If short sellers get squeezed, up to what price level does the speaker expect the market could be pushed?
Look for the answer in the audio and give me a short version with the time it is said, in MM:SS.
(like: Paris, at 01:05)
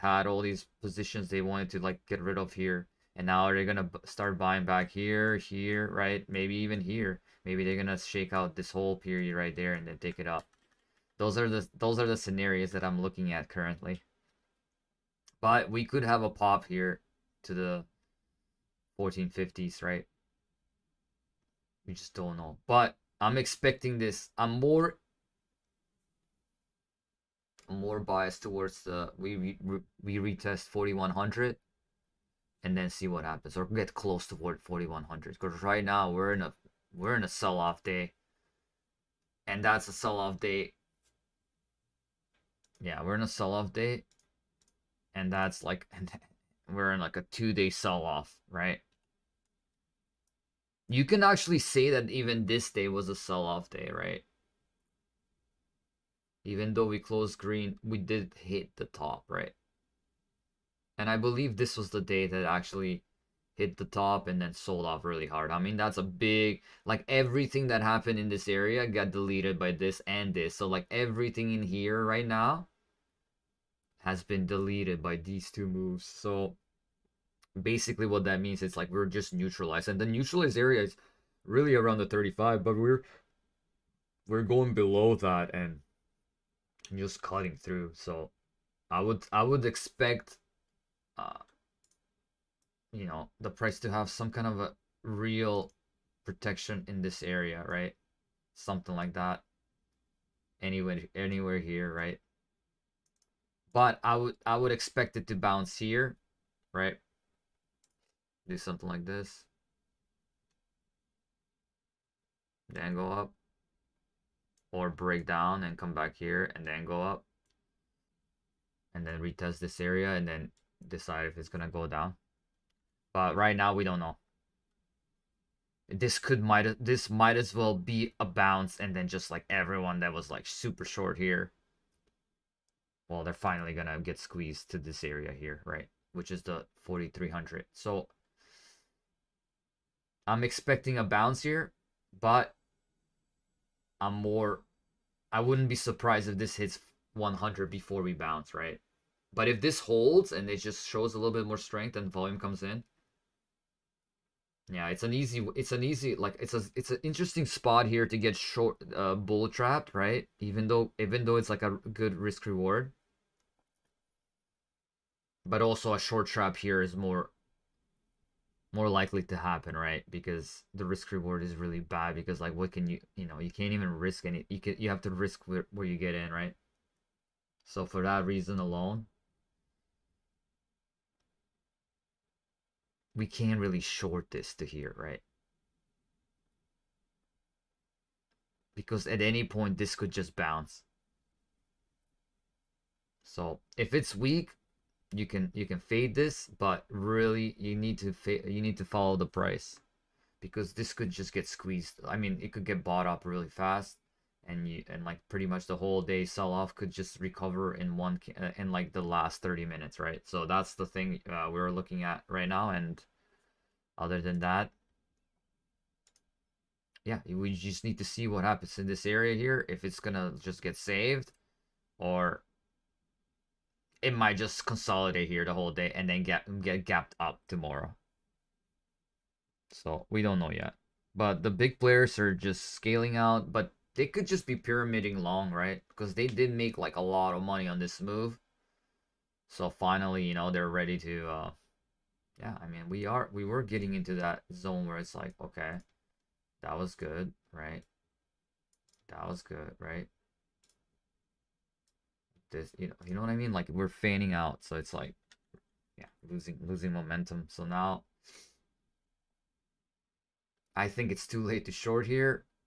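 4300, at 02:16.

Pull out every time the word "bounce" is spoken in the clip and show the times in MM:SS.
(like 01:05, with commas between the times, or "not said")
01:45, 02:08, 02:21, 02:28, 03:10.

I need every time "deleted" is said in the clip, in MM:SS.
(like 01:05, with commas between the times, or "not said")
01:09, 01:14.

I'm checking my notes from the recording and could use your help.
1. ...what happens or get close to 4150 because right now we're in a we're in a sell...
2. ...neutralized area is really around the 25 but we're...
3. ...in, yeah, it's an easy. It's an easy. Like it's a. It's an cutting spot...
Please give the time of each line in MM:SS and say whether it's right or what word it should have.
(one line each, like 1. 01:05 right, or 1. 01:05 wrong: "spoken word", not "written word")
1. 00:33 wrong: "4100", not "4150"
2. 01:20 wrong: "35", not "25"
3. 02:32 wrong: "interesting", not "cutting".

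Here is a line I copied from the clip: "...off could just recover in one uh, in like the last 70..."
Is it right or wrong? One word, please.
wrong.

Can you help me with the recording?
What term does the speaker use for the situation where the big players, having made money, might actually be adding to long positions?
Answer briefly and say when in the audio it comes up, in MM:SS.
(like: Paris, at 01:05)
pyramiding long, at 03:54.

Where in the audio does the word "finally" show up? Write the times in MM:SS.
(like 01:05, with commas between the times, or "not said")
02:13, 03:59.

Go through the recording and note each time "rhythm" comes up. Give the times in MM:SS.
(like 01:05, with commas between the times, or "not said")
not said.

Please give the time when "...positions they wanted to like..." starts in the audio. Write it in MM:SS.
00:00.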